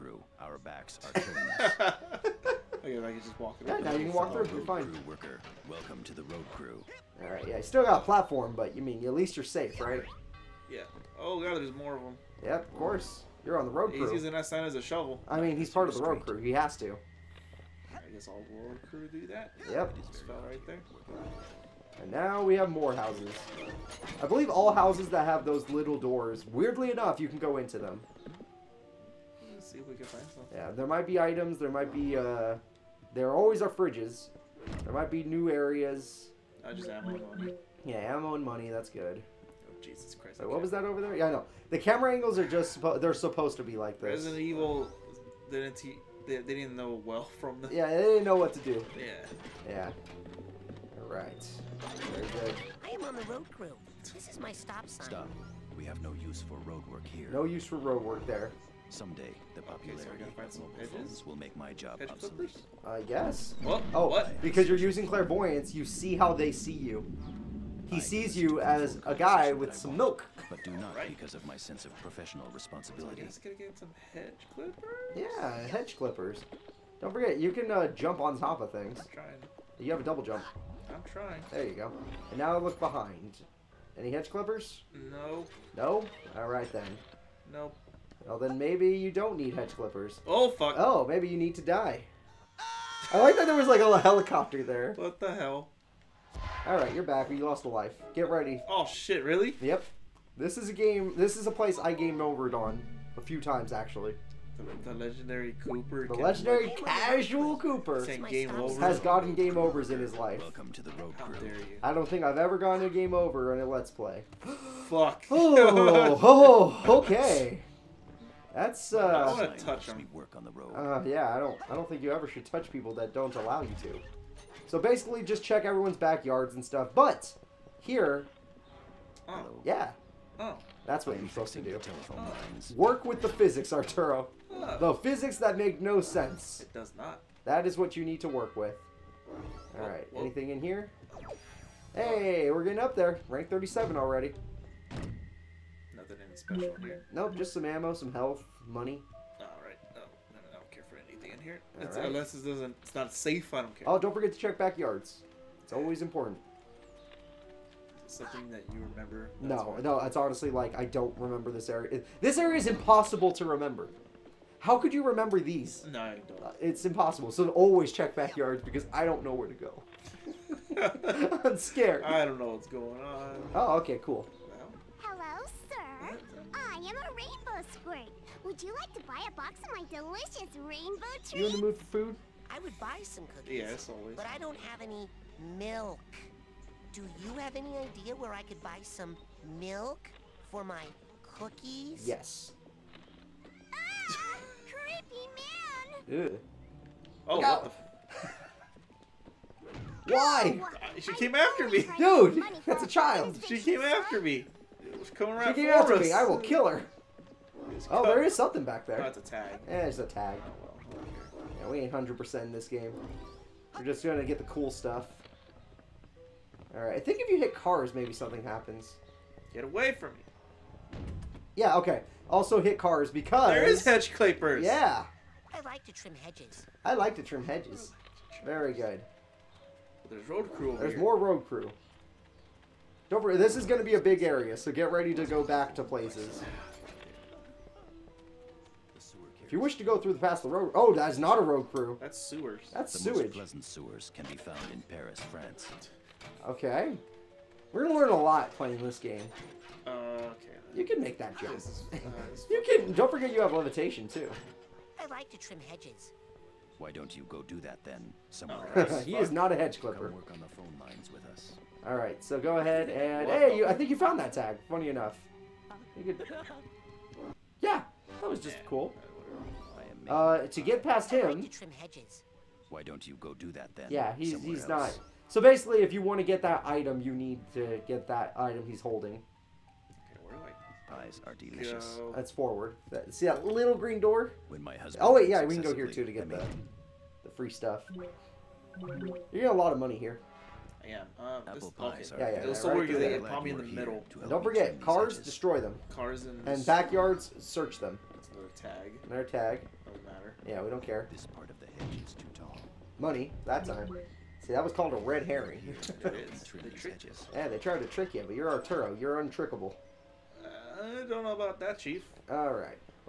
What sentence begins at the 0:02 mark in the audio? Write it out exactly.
okay, I can just walk through.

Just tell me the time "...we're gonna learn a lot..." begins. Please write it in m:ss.
4:07.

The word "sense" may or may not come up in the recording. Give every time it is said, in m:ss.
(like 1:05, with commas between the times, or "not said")
1:11, 2:16.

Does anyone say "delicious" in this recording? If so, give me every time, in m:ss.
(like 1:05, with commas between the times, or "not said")
2:59, 4:41.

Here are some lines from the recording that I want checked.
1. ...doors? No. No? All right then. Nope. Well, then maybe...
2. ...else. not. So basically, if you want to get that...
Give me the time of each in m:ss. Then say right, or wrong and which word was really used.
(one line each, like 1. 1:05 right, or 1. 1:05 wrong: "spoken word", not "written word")
1. 1:24 wrong: "clippers", not "doors"
2. 4:34 right.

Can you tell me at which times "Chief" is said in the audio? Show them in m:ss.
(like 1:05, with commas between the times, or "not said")
5:11.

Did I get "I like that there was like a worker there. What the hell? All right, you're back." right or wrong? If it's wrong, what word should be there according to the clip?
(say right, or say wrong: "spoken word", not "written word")
wrong: "helicopter", not "worker".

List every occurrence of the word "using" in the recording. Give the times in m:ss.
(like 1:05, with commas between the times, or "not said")
0:14, 1:04.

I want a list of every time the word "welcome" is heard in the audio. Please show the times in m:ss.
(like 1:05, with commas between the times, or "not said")
0:05, 1:50.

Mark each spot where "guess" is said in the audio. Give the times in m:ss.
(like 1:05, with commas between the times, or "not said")
0:18, 1:03.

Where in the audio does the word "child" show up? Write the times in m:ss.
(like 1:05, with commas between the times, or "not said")
3:22.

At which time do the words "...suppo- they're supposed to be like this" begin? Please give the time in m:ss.
0:42.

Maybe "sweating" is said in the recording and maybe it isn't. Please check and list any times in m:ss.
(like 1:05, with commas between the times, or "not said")
not said.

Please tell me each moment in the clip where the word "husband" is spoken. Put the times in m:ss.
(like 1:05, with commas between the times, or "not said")
4:44.